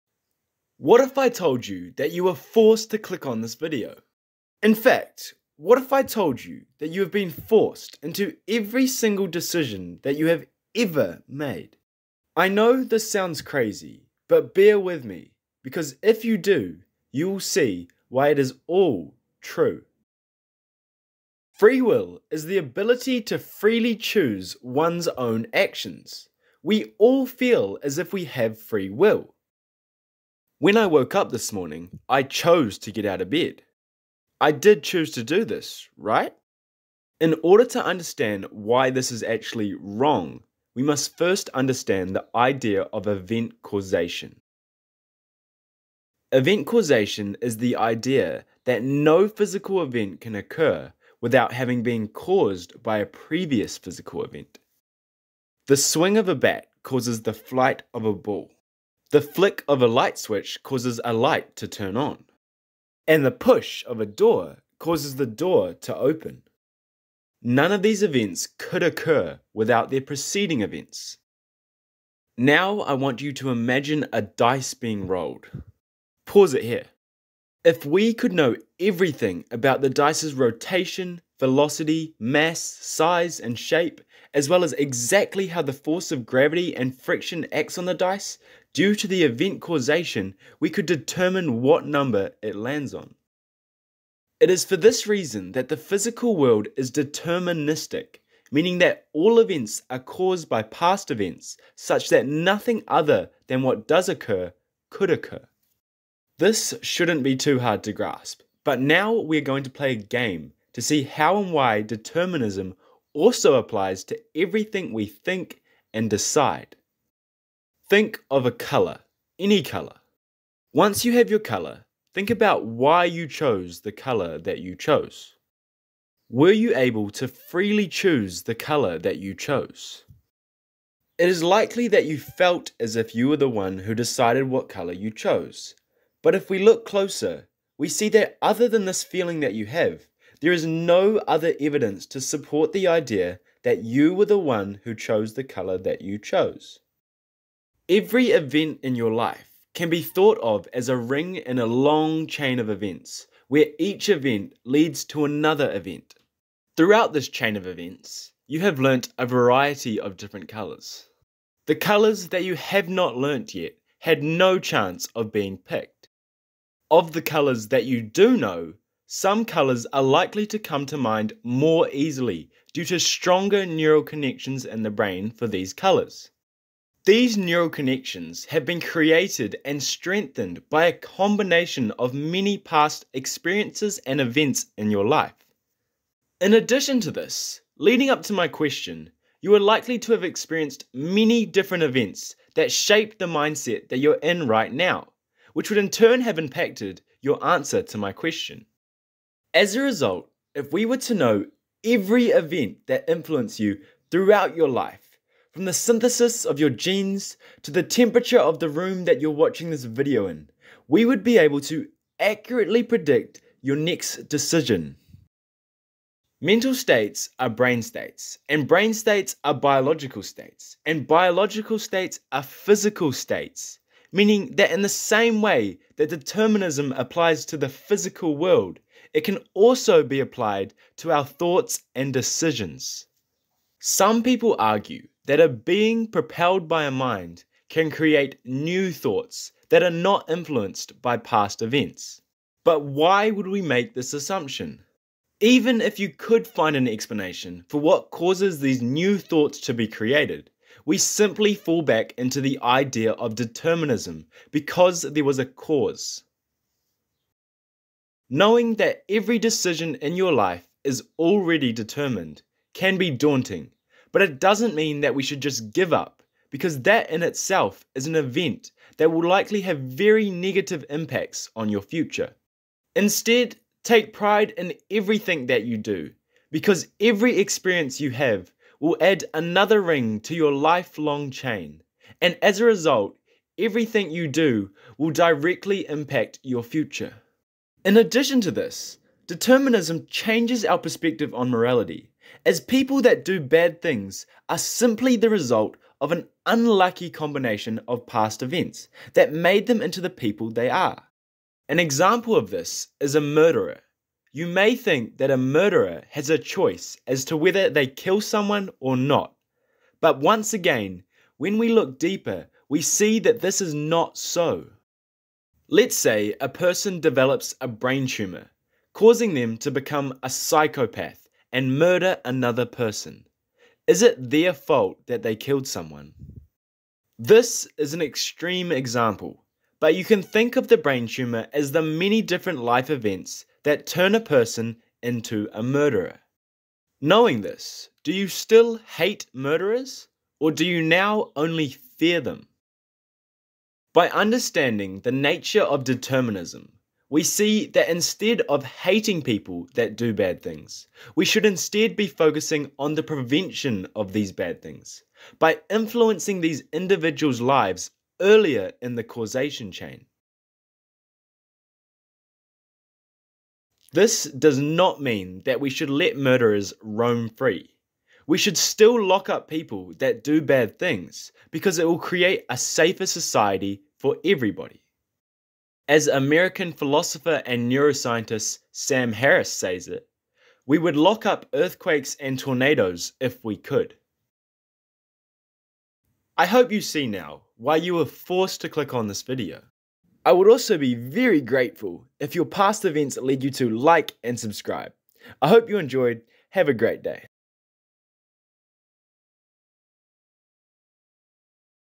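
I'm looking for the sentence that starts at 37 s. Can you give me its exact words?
In order to understand why this is actually wrong, we must first understand the idea of event causation.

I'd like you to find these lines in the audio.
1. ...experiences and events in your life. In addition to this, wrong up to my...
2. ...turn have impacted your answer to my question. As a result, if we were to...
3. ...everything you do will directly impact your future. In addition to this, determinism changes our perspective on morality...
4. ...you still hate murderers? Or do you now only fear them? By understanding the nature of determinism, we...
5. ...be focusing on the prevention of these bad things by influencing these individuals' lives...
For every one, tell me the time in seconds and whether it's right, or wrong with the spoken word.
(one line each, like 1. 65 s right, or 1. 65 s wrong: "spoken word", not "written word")
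1. 183 s wrong: "leading", not "wrong"
2. 195 s right
3. 283 s right
4. 338 s right
5. 351 s right.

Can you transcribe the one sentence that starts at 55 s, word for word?
The swing of a bat causes the flight of a ball.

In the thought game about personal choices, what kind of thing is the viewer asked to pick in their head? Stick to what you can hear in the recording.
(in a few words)
A colour.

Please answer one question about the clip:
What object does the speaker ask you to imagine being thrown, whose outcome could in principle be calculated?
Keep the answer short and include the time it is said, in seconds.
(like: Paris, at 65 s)
A dice, at 74 s.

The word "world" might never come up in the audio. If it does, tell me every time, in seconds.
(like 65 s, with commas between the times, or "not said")
96 s, 228 s.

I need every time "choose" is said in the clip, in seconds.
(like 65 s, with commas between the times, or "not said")
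23 s, 34 s, 127 s.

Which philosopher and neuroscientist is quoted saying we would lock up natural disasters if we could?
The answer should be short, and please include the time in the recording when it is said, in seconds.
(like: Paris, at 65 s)
Sam Harris, at 378 s.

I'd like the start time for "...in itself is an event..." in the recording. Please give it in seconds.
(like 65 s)
267 s.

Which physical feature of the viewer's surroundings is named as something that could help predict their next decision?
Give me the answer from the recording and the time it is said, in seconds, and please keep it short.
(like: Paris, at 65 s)
Temperature of the room, at 207 s.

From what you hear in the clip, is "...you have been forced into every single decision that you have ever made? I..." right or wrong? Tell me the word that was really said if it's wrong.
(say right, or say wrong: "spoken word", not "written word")
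right.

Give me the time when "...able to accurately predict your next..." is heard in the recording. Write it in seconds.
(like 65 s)
211 s.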